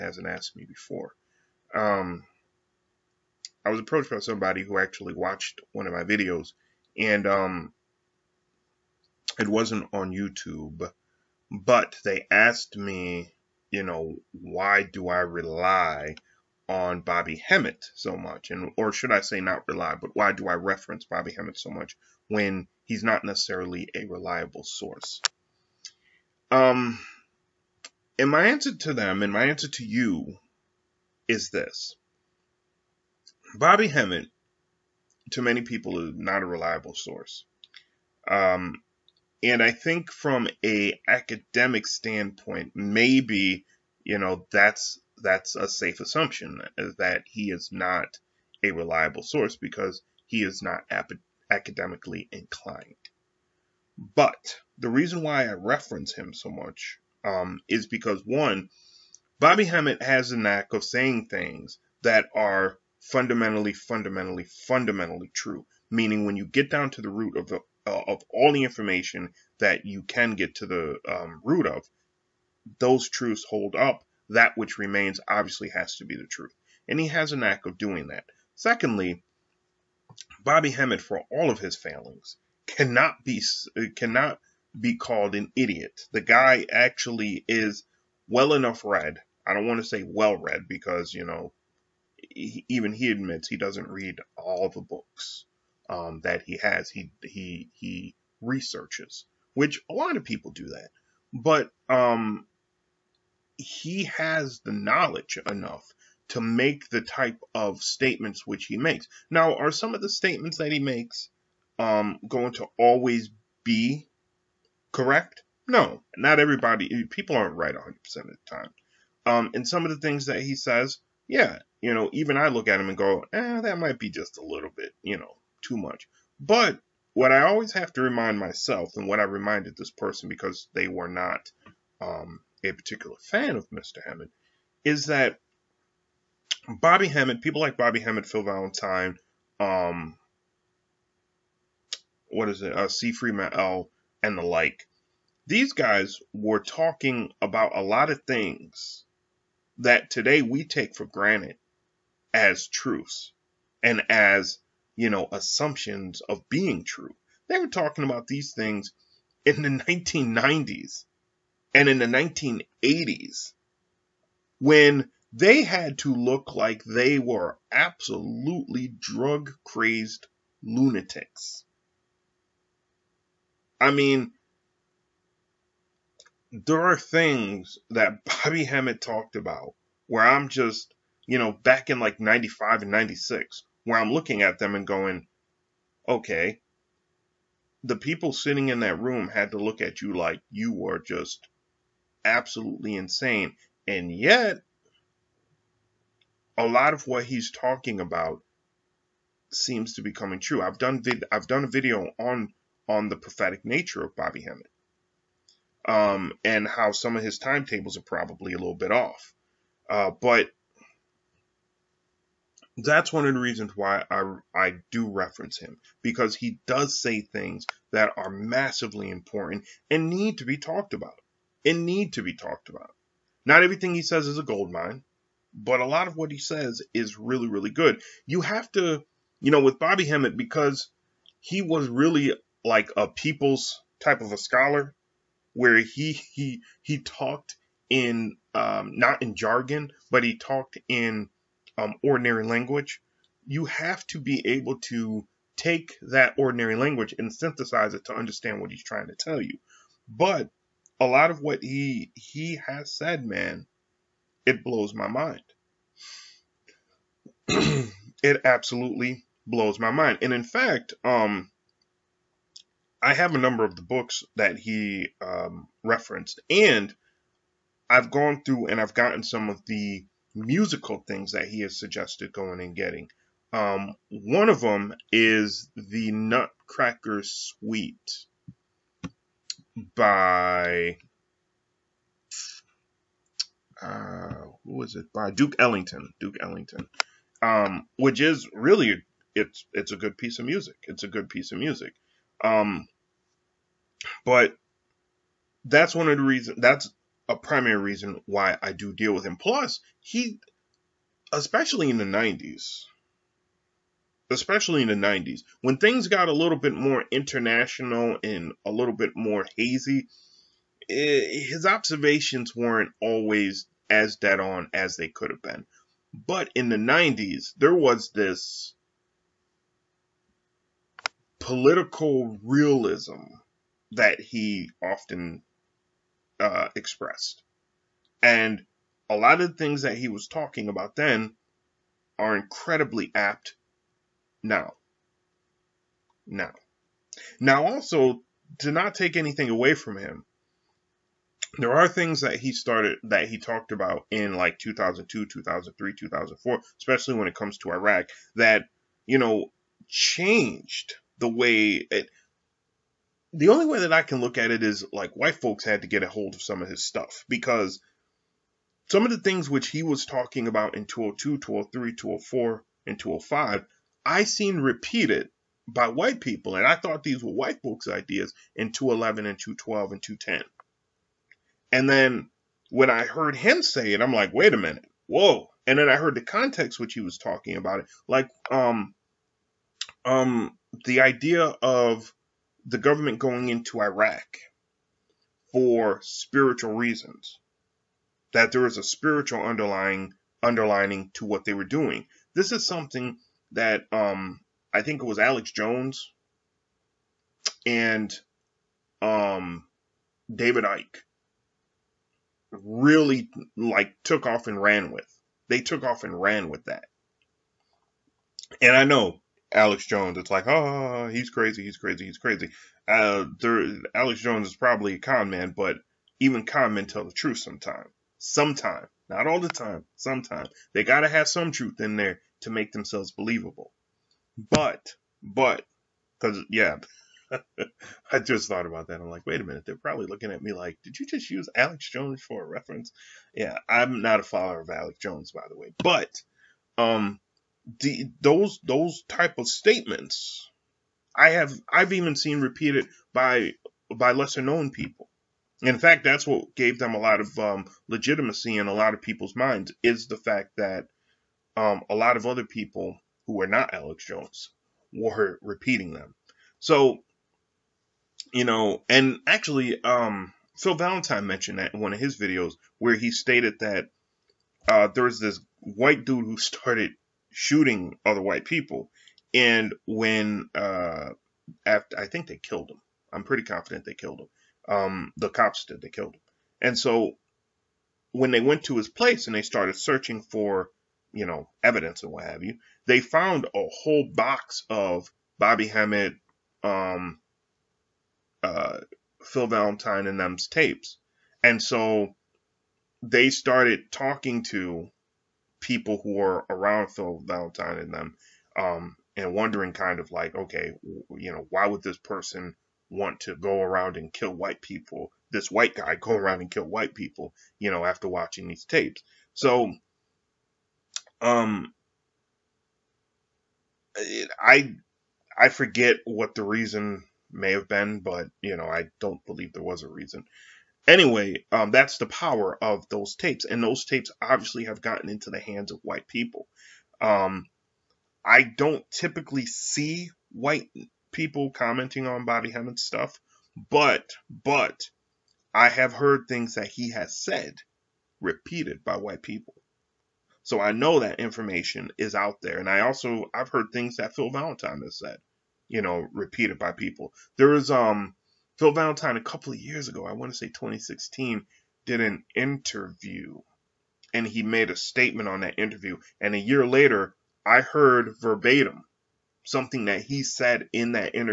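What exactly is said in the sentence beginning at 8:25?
This white guy go around and kill white people, you know, after watching these tapes.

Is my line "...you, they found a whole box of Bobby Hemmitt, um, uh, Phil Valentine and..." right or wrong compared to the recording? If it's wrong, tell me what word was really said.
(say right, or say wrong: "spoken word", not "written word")
right.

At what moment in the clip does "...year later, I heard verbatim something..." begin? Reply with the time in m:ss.
9:16.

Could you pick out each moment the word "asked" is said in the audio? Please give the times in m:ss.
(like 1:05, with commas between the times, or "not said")
0:00, 0:12.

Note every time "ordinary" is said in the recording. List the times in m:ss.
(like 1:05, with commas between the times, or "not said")
4:02, 4:06.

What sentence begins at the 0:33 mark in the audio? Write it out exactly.
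Bobby Hemmitt, to many people, is not a reliable source.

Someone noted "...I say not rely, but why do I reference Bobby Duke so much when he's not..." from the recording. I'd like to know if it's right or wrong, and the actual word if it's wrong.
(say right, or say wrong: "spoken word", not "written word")
wrong: "Hemmitt", not "Duke".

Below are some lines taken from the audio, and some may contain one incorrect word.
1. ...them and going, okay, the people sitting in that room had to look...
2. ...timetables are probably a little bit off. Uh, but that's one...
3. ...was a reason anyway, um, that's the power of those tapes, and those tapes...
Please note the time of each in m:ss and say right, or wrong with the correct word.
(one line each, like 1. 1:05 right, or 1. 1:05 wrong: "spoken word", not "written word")
1. 3:04 right
2. 3:27 right
3. 8:39 right.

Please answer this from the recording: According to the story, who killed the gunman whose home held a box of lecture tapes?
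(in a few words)
the cops.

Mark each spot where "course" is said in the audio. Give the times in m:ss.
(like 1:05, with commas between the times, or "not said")
not said.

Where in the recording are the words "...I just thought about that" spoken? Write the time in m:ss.
7:08.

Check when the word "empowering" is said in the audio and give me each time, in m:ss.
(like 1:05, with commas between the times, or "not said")
not said.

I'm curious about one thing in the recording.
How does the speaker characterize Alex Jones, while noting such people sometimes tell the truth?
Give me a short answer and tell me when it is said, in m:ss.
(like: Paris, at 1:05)
con man, at 6:54.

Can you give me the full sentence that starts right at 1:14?
That which remains obviously has to be the truth.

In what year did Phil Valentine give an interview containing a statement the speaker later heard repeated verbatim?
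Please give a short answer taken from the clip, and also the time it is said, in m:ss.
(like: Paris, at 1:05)
2016, at 9:10.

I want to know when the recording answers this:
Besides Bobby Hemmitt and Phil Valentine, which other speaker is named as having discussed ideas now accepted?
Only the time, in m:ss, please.
2:22.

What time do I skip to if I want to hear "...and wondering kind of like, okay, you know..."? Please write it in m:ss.
8:19.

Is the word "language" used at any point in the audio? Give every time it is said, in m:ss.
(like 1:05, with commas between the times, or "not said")
4:02, 4:06.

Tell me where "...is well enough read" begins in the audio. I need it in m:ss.
1:27.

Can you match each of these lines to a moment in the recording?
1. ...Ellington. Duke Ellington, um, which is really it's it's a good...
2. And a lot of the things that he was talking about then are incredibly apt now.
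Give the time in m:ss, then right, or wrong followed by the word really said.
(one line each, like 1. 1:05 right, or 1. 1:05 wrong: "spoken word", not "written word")
1. 4:45 right
2. 5:28 right.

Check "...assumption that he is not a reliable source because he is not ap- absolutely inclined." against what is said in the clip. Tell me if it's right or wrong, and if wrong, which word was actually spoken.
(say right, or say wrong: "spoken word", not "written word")
wrong: "academically", not "absolutely".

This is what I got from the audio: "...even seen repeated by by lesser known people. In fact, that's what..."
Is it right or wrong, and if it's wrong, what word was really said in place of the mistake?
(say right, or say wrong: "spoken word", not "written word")
right.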